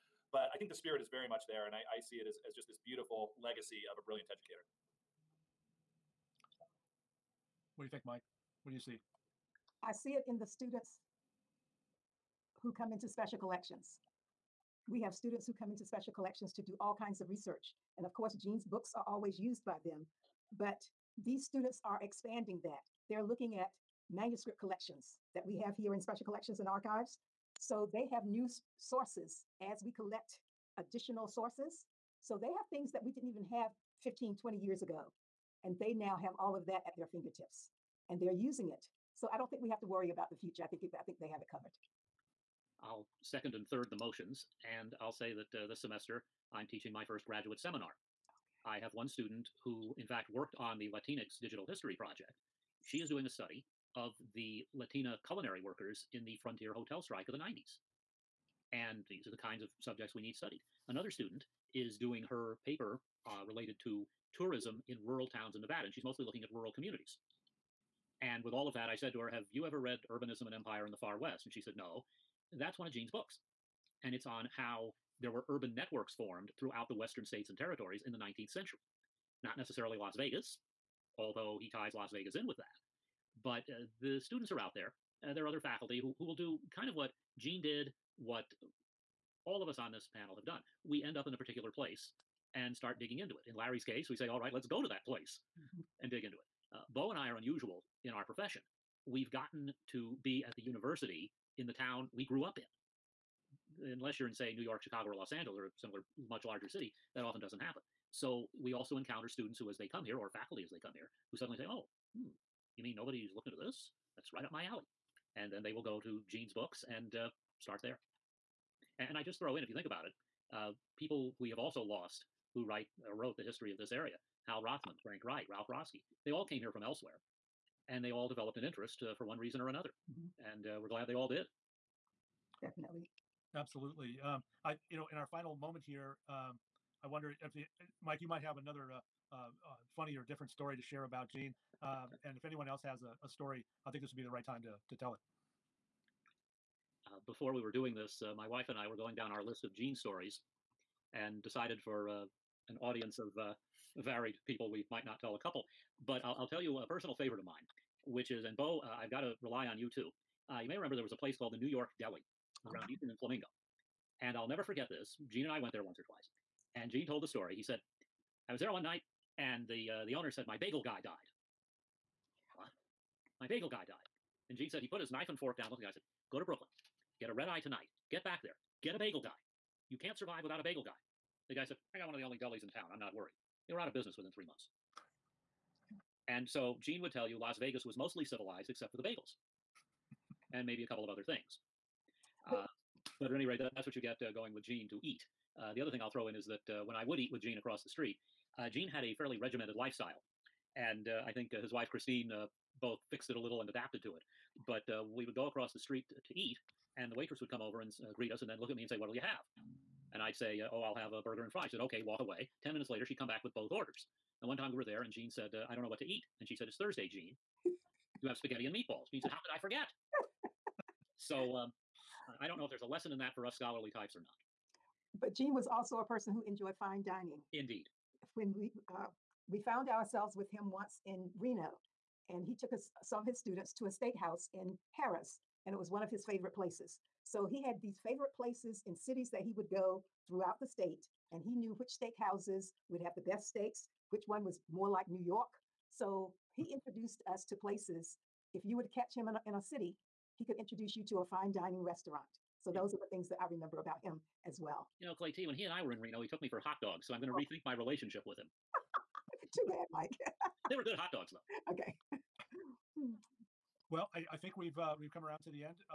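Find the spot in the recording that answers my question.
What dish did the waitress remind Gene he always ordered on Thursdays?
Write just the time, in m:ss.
3:38.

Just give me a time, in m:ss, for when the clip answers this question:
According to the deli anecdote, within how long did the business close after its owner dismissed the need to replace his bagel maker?
3:04.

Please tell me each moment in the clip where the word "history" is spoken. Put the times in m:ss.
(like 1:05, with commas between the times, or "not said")
0:51, 2:03.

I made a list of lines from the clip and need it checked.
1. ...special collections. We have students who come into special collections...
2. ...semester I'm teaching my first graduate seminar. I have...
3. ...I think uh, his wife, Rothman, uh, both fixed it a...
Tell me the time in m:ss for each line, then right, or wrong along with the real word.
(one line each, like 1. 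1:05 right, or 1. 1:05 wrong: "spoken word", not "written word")
1. 0:13 right
2. 0:45 right
3. 3:21 wrong: "Christine", not "Rothman".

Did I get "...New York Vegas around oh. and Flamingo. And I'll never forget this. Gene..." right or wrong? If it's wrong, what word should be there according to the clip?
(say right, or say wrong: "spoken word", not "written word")
wrong: "Deli", not "Vegas".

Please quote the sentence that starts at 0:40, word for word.
I think it, I think they have it covered.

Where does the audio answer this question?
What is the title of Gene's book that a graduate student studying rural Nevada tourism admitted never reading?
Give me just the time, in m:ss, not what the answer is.
1:10.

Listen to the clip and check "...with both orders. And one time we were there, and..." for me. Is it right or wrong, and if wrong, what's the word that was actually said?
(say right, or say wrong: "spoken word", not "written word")
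right.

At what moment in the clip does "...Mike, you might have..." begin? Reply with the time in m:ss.
2:18.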